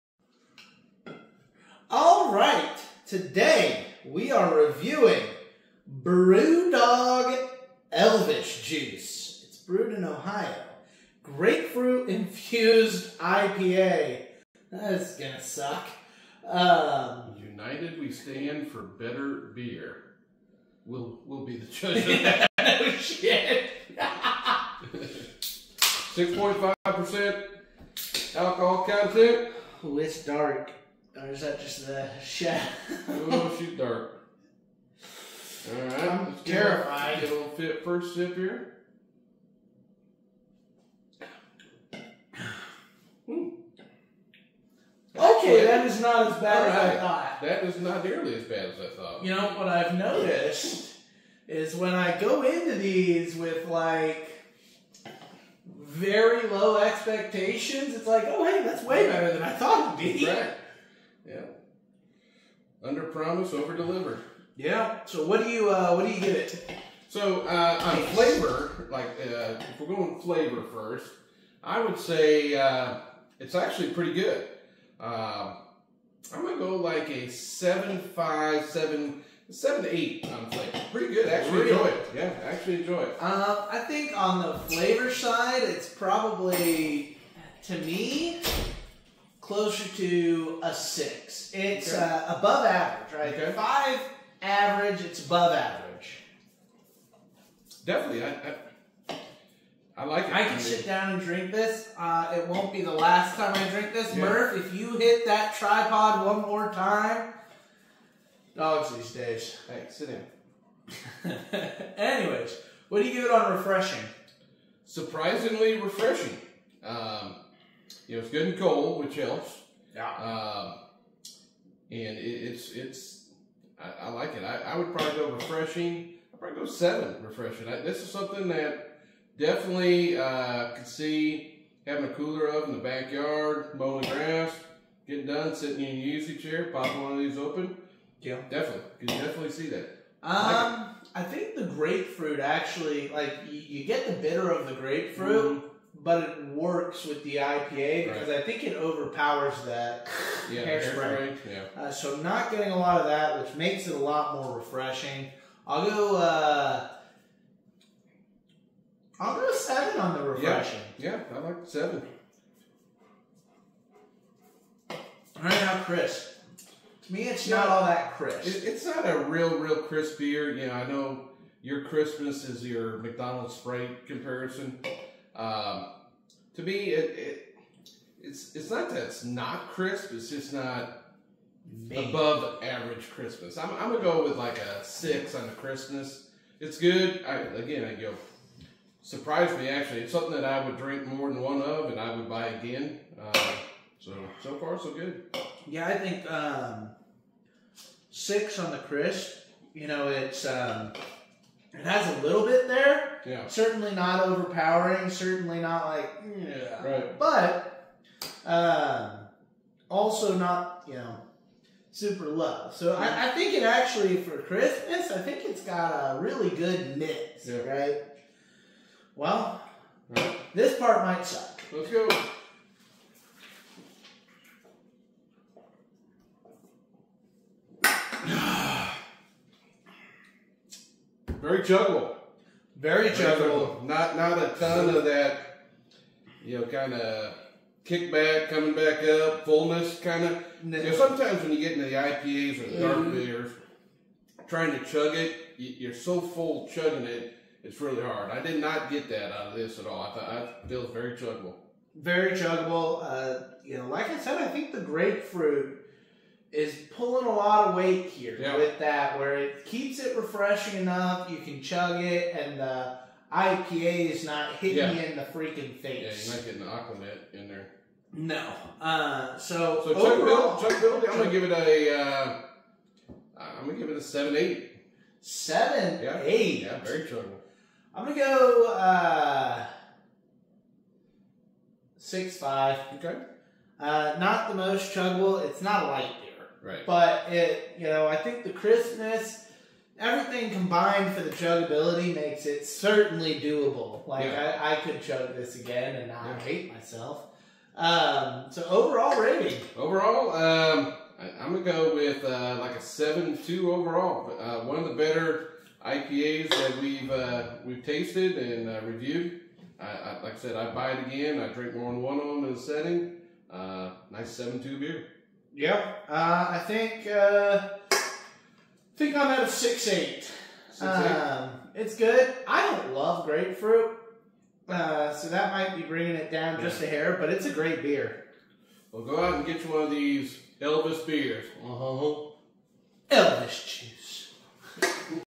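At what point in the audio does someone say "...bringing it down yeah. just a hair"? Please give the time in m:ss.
5:25.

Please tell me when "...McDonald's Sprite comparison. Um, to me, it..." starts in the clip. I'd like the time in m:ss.
2:52.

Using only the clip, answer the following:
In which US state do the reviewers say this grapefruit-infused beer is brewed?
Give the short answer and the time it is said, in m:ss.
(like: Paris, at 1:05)
Ohio, at 0:10.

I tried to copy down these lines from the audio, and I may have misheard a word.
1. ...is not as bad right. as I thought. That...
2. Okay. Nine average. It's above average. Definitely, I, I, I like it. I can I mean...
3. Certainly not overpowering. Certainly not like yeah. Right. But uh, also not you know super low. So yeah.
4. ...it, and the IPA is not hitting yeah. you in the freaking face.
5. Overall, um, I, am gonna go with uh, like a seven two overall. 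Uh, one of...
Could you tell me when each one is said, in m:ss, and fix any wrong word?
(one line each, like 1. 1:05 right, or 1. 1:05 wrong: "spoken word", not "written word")
1. 0:45 right
2. 1:33 wrong: "Five", not "Nine"
3. 3:23 right
4. 4:22 right
5. 4:59 right.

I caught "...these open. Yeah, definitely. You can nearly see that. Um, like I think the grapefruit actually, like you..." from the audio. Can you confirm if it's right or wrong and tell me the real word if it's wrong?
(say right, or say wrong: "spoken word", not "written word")
wrong: "definitely", not "nearly".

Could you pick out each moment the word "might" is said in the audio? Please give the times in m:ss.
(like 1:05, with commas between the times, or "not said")
3:41, 5:25.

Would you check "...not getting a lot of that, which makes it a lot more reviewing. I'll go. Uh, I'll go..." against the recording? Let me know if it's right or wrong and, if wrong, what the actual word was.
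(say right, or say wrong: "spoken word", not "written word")
wrong: "refreshing", not "reviewing".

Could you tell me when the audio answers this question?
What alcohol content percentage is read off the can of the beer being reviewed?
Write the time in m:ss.
0:25.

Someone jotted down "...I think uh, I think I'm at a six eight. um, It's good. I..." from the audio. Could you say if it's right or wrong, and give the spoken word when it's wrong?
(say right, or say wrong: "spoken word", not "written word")
right.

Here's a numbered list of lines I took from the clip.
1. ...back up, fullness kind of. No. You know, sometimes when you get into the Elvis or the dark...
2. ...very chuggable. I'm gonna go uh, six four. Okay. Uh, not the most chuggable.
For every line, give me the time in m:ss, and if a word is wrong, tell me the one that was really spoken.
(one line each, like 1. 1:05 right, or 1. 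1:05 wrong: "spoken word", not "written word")
1. 3:58 wrong: "IPAs", not "Elvis"
2. 4:36 wrong: "five", not "four".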